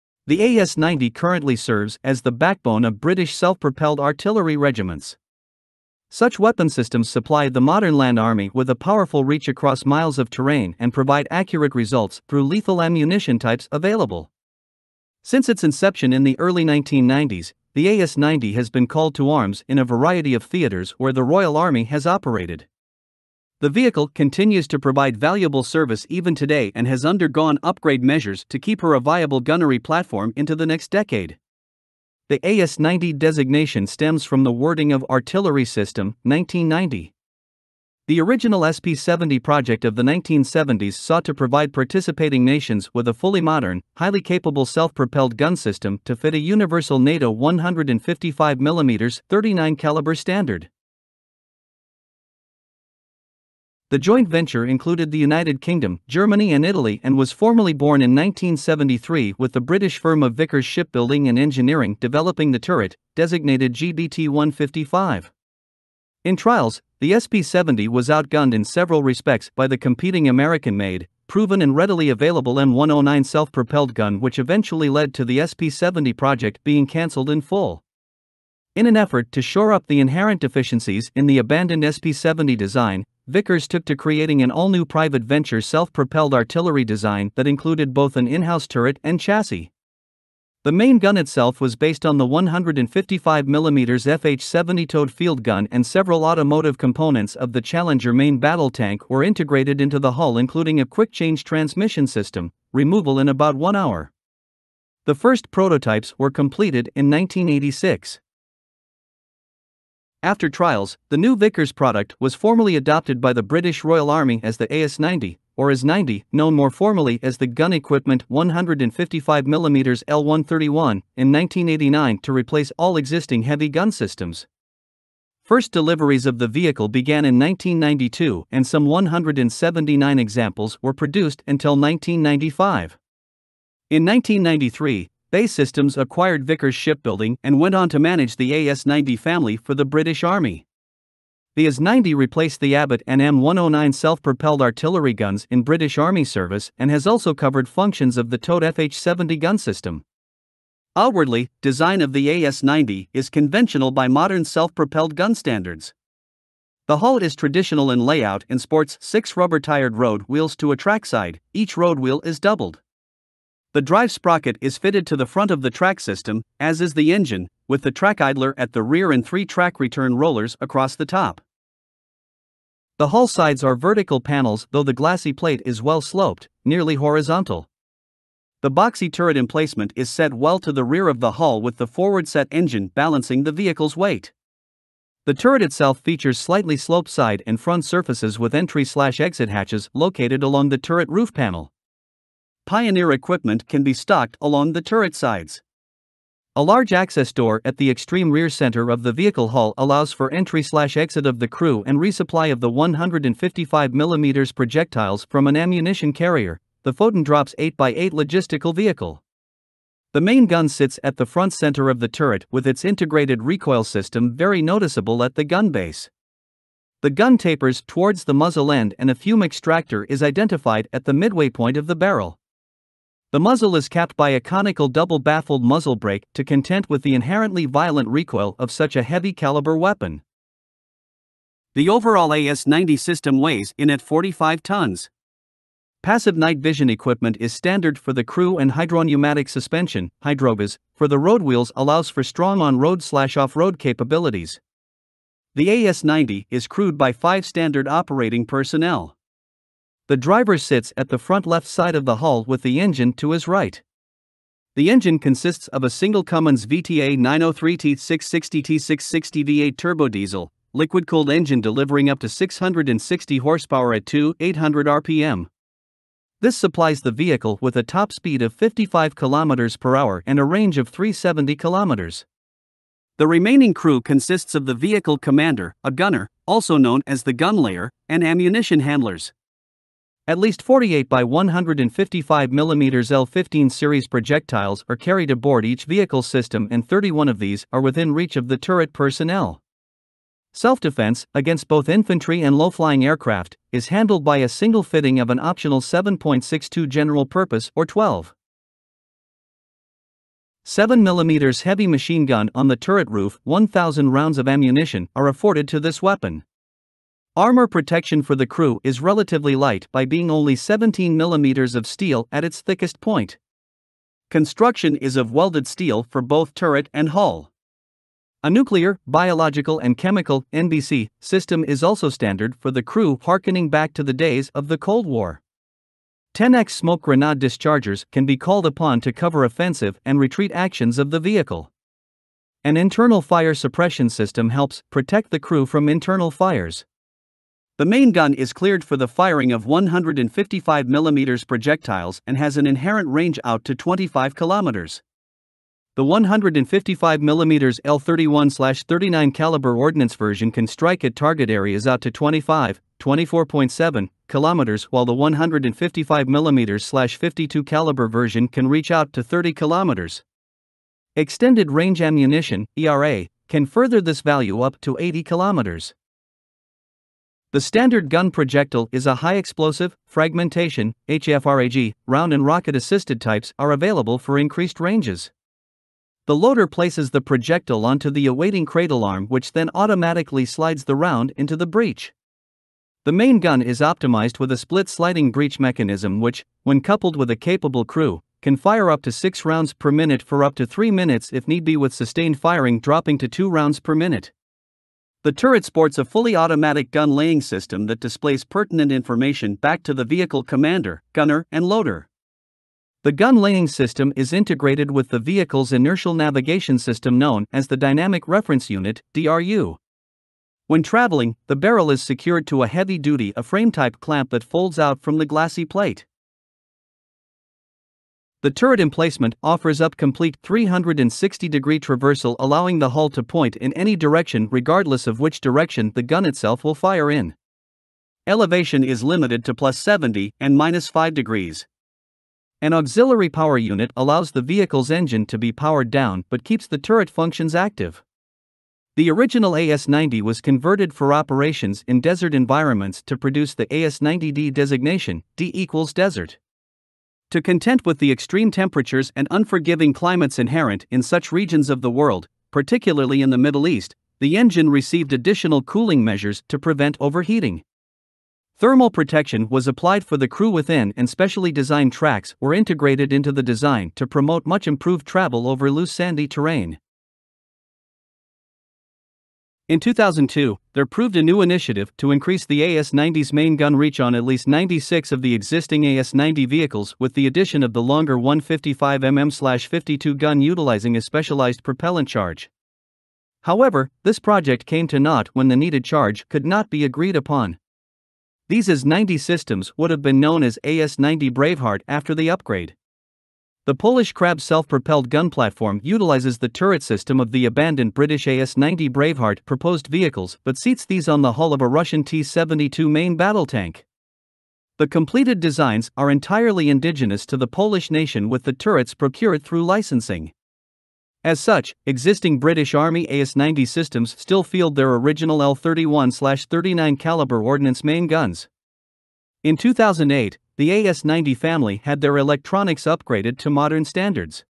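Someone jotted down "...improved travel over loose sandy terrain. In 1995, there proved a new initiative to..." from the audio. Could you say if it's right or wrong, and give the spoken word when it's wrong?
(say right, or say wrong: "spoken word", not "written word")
wrong: "2002", not "1995".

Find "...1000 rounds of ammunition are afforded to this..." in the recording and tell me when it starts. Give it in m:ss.
5:03.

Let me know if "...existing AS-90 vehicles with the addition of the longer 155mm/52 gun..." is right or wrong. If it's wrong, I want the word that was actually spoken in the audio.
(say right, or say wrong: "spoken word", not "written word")
right.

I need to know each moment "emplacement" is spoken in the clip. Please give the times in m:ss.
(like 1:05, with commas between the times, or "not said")
2:59, 6:58.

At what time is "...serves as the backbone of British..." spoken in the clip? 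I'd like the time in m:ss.
0:01.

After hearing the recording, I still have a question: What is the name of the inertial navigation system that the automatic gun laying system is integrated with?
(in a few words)
Dynamic Reference Unit.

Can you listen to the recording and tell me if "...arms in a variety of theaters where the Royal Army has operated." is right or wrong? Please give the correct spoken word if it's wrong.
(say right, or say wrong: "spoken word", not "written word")
right.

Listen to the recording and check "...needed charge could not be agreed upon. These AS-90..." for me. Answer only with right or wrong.
right.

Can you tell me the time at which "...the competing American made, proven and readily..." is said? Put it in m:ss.
1:09.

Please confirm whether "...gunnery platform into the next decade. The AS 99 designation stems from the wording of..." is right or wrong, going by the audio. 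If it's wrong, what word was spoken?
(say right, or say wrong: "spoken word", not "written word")
wrong: "90", not "99".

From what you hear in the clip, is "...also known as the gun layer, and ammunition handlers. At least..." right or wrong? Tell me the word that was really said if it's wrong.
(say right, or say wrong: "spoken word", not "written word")
right.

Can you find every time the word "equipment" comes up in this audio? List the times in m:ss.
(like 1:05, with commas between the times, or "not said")
1:57, 3:13, 3:56.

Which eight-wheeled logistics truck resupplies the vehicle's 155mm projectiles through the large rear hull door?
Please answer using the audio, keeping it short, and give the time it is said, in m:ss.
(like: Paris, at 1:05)
Foden Drops, at 3:26.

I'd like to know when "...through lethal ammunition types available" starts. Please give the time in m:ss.
0:12.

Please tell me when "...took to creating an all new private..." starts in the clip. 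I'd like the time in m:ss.
1:23.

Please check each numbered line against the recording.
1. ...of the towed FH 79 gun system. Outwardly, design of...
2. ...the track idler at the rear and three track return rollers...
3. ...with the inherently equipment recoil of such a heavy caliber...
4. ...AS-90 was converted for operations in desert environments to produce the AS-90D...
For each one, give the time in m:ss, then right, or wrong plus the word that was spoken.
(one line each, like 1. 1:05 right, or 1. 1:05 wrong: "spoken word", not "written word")
1. 2:28 wrong: "70", not "79"
2. 2:47 right
3. 3:46 wrong: "violent", not "equipment"
4. 7:19 right.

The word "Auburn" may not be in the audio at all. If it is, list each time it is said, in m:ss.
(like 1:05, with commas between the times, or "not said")
not said.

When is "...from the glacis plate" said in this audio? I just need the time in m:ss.
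6:55.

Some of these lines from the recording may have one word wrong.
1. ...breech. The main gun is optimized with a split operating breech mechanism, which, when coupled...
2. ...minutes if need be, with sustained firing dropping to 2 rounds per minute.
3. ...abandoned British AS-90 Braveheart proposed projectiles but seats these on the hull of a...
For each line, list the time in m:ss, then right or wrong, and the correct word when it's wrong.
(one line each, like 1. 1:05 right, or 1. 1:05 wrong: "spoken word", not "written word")
1. 6:21 wrong: "sliding", not "operating"
2. 6:30 right
3. 8:17 wrong: "vehicles", not "projectiles".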